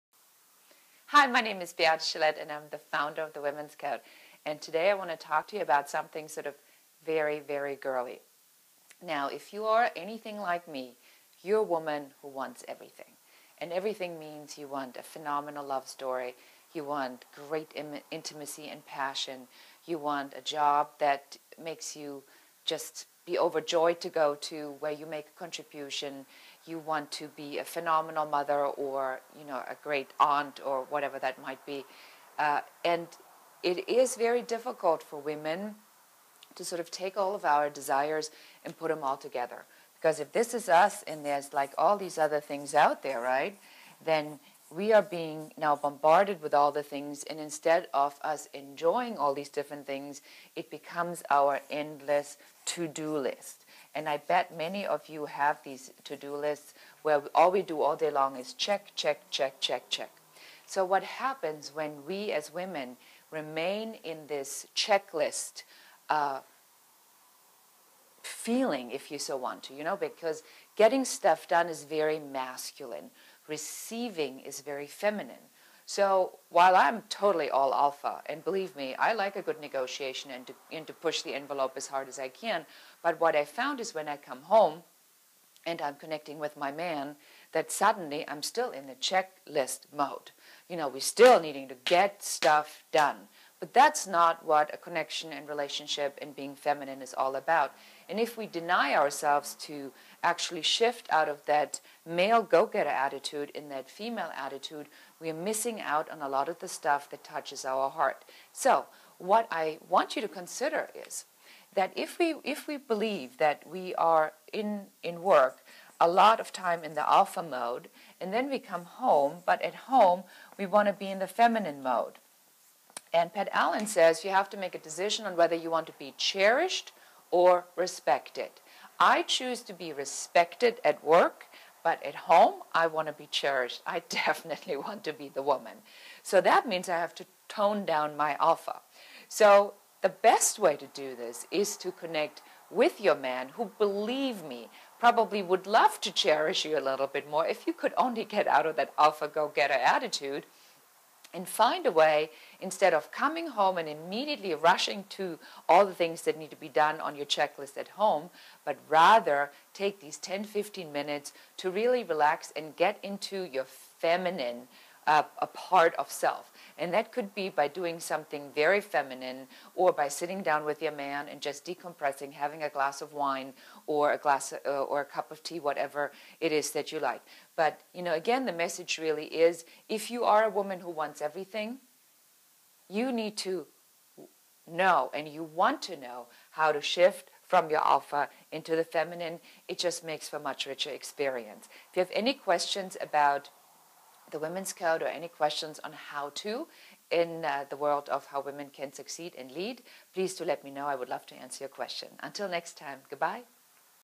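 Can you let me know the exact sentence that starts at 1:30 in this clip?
You know, we're still needing to get stuff done.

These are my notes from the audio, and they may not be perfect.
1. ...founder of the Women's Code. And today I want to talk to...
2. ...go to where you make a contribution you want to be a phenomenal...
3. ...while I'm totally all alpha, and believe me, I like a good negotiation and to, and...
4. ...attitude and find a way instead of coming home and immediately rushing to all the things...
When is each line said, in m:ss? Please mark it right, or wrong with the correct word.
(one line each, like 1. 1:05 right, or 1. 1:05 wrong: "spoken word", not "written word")
1. 0:02 right
2. 0:24 right
3. 1:16 right
4. 2:29 right.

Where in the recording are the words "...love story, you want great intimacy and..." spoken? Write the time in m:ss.
0:15.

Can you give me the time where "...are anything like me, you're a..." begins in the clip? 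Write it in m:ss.
0:09.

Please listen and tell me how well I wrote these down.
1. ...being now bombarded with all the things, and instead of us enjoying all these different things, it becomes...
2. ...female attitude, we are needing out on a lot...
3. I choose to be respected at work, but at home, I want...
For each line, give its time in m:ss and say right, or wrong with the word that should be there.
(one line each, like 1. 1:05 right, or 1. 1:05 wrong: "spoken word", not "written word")
1. 0:45 right
2. 1:43 wrong: "missing", not "needing"
3. 2:08 right.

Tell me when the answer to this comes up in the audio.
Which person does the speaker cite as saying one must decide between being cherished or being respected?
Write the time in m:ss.
2:03.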